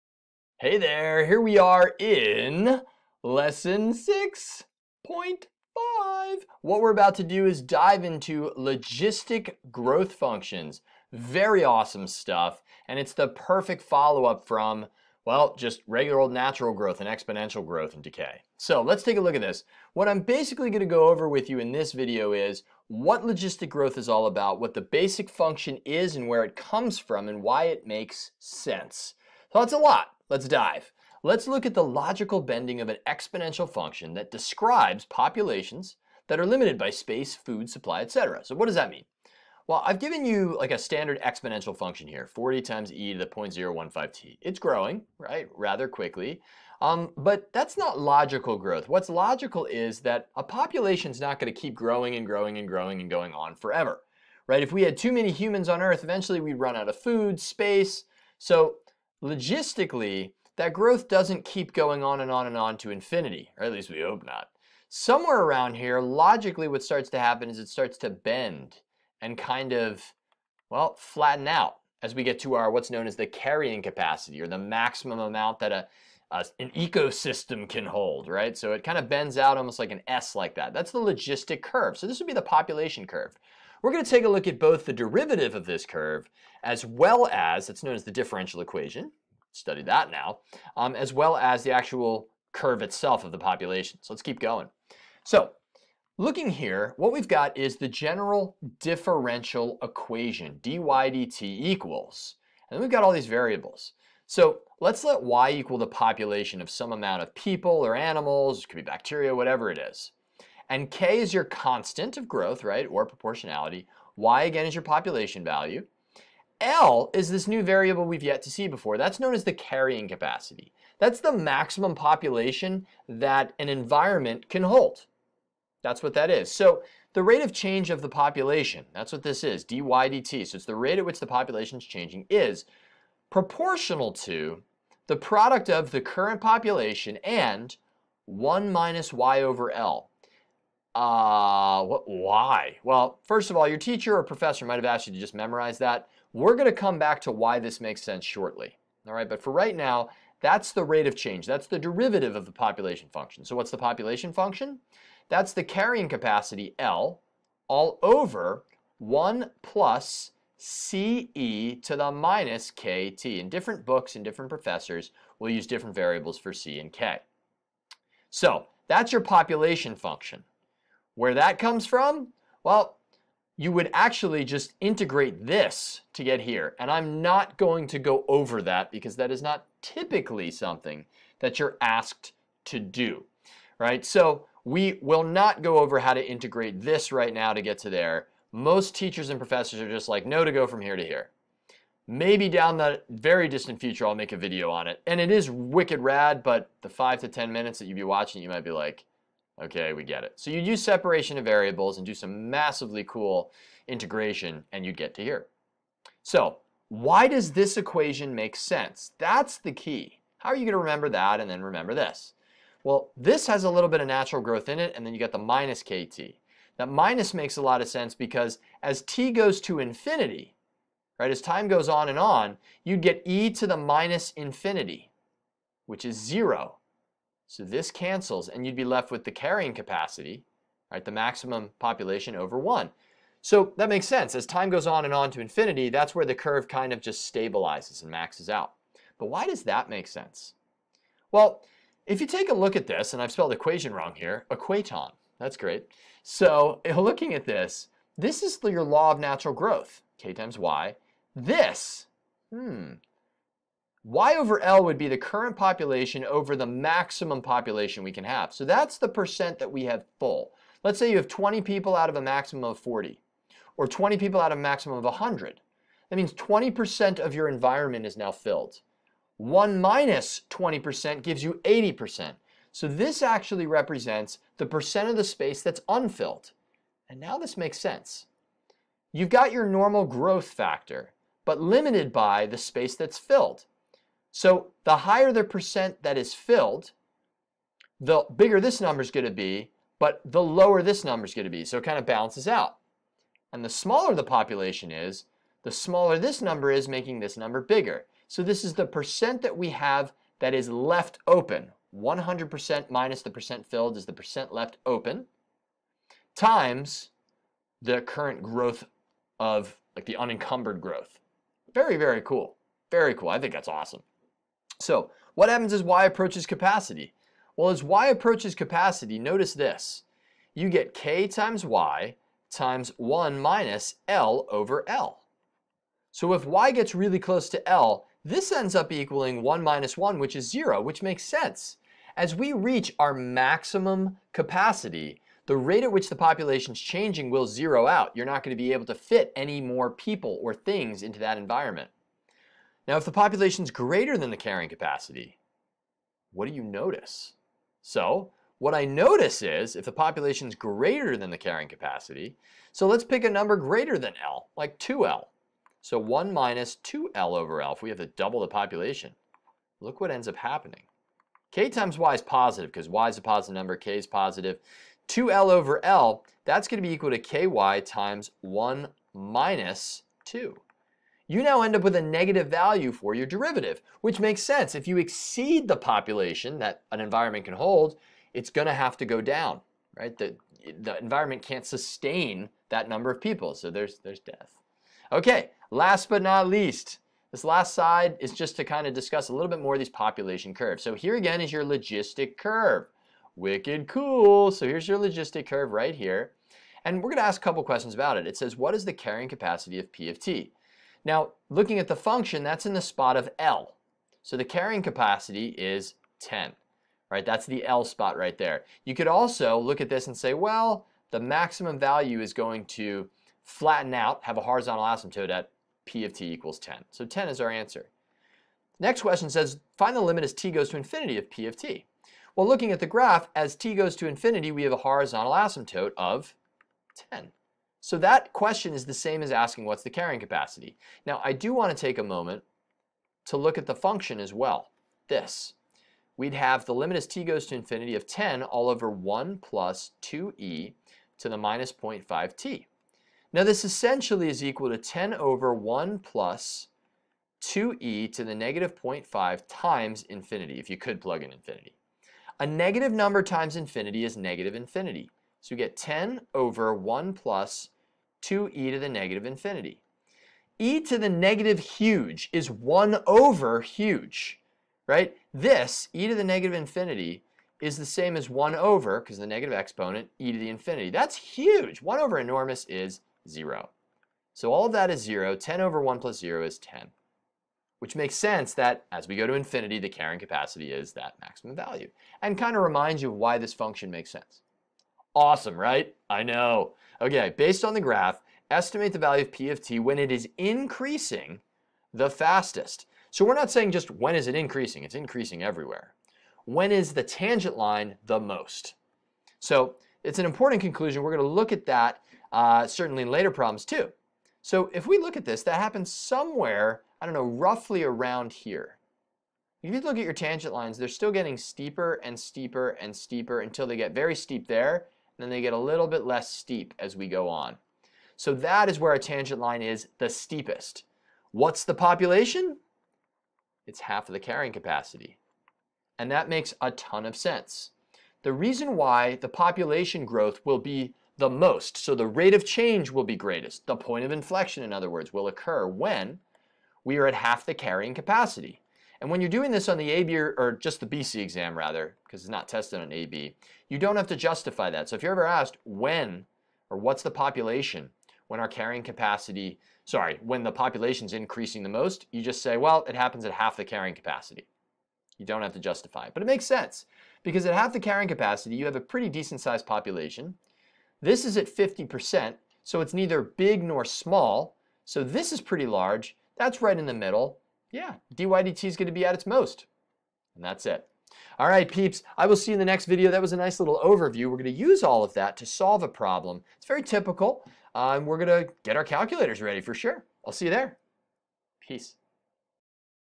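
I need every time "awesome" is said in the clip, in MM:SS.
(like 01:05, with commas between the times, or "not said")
00:11, 05:13, 08:05.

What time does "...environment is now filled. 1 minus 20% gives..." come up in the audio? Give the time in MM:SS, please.
04:27.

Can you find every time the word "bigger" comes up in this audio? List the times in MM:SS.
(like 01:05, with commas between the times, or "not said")
04:48, 04:57.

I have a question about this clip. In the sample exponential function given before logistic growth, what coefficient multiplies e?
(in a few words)
40.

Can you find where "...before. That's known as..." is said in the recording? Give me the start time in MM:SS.
01:58.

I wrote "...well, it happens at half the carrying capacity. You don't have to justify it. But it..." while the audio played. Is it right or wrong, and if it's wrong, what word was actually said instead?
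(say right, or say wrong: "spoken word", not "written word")
right.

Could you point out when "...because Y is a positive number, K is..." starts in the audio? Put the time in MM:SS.
06:02.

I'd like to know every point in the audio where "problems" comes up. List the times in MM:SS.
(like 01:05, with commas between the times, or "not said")
08:23, 09:35.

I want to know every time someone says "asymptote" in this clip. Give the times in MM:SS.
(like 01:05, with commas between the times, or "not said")
06:54, 07:05.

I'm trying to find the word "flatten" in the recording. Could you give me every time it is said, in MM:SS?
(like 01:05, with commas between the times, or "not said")
01:10, 06:53.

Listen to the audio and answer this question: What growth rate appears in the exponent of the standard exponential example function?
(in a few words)
0.015.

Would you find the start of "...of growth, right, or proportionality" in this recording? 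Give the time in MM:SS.
01:52.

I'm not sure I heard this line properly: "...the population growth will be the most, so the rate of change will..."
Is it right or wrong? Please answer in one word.
right.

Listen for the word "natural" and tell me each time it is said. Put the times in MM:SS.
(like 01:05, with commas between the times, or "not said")
00:16, 03:34, 04:09.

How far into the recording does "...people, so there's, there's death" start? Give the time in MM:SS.
06:23.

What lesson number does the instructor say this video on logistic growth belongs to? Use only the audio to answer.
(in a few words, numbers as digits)
6.5.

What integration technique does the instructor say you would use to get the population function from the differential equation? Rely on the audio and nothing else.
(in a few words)
separation of variables.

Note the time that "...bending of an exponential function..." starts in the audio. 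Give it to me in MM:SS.
00:32.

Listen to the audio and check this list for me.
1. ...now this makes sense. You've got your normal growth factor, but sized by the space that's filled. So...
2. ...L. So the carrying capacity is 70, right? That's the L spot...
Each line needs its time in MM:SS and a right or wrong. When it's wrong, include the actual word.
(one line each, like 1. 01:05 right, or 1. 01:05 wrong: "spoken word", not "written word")
1. 04:37 wrong: "limited", not "sized"
2. 06:43 wrong: "10", not "70".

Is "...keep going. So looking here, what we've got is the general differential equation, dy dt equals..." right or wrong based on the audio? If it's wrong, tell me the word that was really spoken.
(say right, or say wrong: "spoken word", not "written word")
right.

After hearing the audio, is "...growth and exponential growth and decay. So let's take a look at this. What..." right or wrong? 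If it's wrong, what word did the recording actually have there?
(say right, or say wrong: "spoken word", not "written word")
right.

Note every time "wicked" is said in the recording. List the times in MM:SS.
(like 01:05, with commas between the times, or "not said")
03:15, 06:33.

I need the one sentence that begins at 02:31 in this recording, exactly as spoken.
That's the derivative of the population function.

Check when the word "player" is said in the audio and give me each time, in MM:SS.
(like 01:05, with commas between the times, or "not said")
not said.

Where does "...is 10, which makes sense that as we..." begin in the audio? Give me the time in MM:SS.
07:56.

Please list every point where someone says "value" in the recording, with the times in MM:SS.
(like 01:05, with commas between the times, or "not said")
01:55, 06:12, 06:51, 08:01, 08:08.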